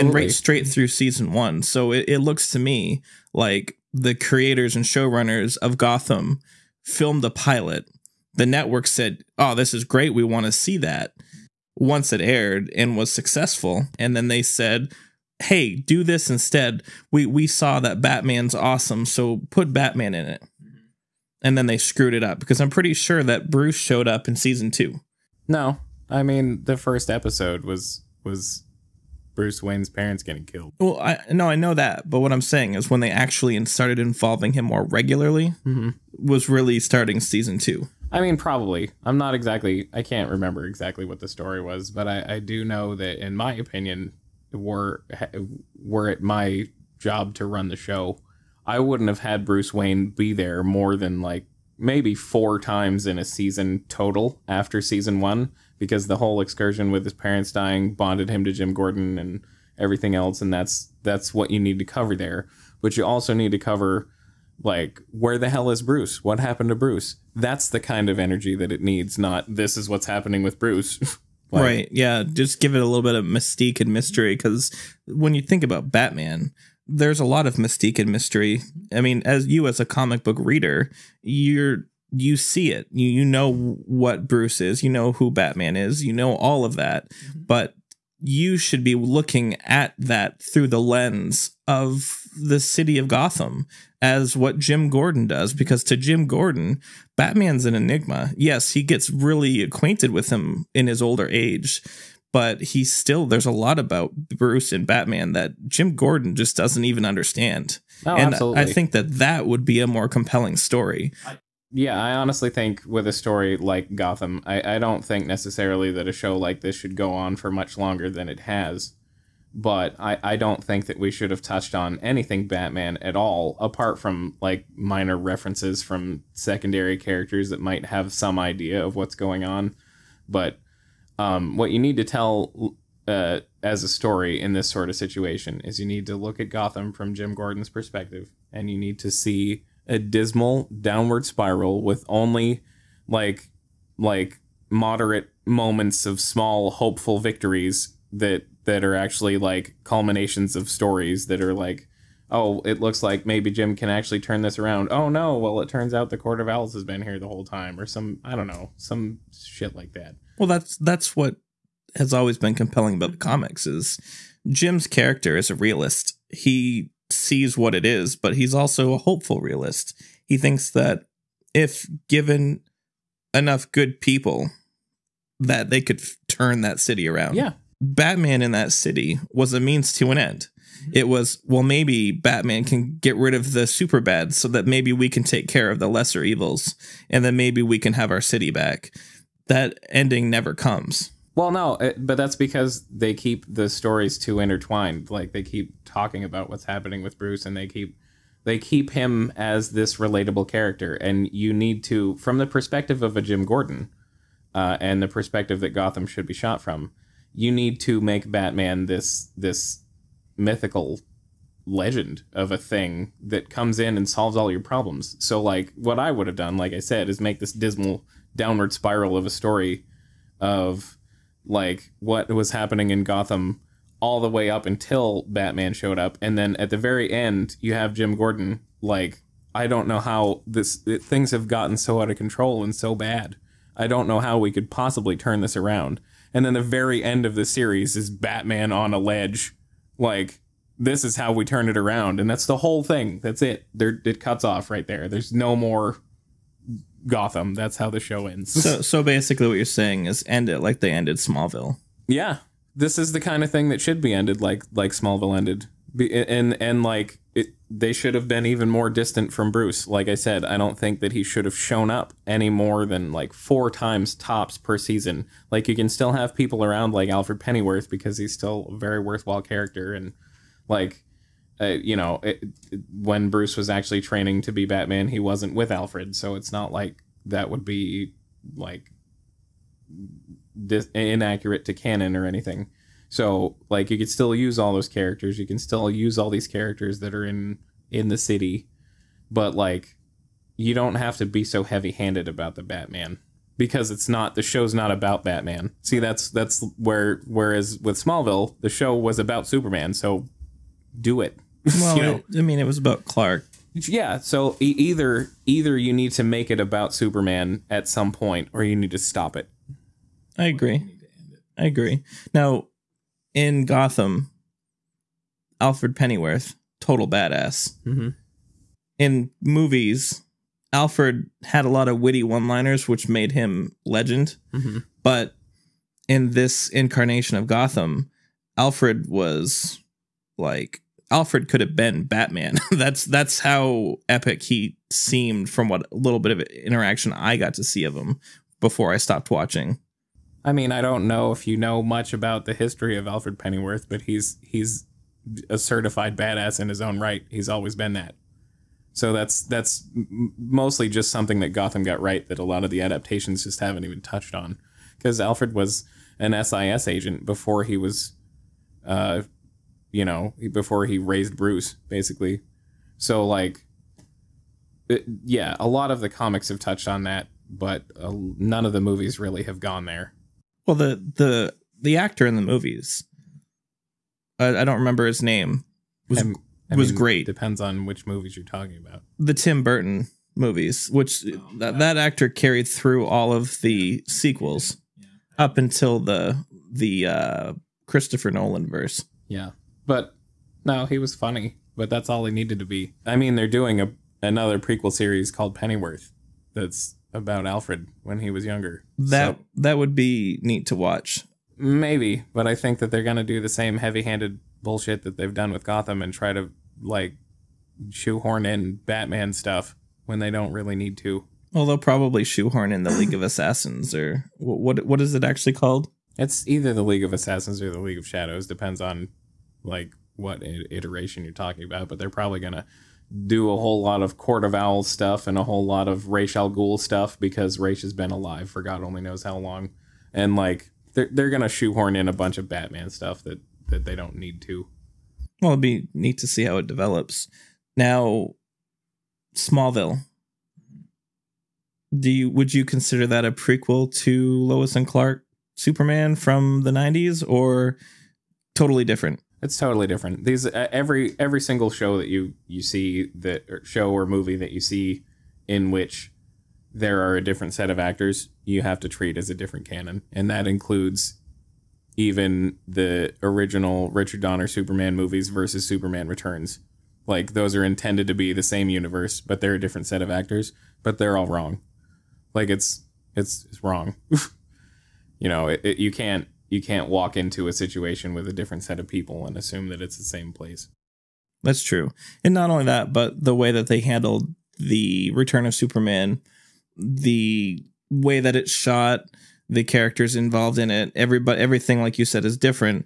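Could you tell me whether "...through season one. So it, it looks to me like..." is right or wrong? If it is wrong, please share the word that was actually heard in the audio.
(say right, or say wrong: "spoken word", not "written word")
right.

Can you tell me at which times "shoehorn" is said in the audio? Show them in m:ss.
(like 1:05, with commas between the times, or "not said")
6:47, 6:52, 7:11.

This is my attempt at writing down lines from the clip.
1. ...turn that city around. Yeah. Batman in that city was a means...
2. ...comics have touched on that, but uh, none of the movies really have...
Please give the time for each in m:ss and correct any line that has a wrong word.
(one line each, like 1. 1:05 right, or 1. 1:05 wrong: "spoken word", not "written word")
1. 2:56 right
2. 6:06 right.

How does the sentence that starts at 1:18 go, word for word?
I mean, as you as a comic book reader, you're you see it.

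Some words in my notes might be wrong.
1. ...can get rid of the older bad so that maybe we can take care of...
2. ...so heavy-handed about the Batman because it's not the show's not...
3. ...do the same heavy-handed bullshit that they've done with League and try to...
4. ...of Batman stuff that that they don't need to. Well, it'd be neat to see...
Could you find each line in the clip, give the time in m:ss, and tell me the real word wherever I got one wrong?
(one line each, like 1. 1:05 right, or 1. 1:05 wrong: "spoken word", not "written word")
1. 3:02 wrong: "super", not "older"
2. 4:51 right
3. 6:43 wrong: "Gotham", not "League"
4. 7:12 right.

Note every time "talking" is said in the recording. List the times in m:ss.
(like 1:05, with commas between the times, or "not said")
3:15, 6:18, 7:01.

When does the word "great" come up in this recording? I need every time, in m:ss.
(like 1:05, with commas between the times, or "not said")
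0:09, 6:16.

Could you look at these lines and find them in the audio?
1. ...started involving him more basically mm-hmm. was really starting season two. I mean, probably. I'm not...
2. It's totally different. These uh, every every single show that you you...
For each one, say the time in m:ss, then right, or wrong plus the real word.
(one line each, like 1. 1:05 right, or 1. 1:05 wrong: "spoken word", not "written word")
1. 0:33 wrong: "regularly", not "basically"
2. 7:29 right.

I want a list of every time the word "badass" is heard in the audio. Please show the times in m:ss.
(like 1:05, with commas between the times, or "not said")
5:17, 5:46.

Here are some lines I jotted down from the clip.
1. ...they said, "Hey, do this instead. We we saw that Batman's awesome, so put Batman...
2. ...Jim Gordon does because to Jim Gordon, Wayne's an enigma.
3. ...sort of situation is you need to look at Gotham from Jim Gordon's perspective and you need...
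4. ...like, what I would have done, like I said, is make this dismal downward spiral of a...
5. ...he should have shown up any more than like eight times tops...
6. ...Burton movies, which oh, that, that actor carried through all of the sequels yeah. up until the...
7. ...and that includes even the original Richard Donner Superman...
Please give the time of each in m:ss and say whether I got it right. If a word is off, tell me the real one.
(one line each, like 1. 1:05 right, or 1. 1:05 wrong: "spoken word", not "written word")
1. 0:14 right
2. 1:34 wrong: "Batman", not "Wayne"
3. 2:14 right
4. 3:35 right
5. 4:21 wrong: "four", not "eight"
6. 6:19 right
7. 7:40 right.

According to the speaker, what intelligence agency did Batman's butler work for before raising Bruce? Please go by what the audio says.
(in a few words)
SIS.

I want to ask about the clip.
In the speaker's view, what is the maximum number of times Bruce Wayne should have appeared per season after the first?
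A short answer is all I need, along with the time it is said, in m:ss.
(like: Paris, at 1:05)
4, at 0:52.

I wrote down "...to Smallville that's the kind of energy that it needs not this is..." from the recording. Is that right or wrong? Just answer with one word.
wrong.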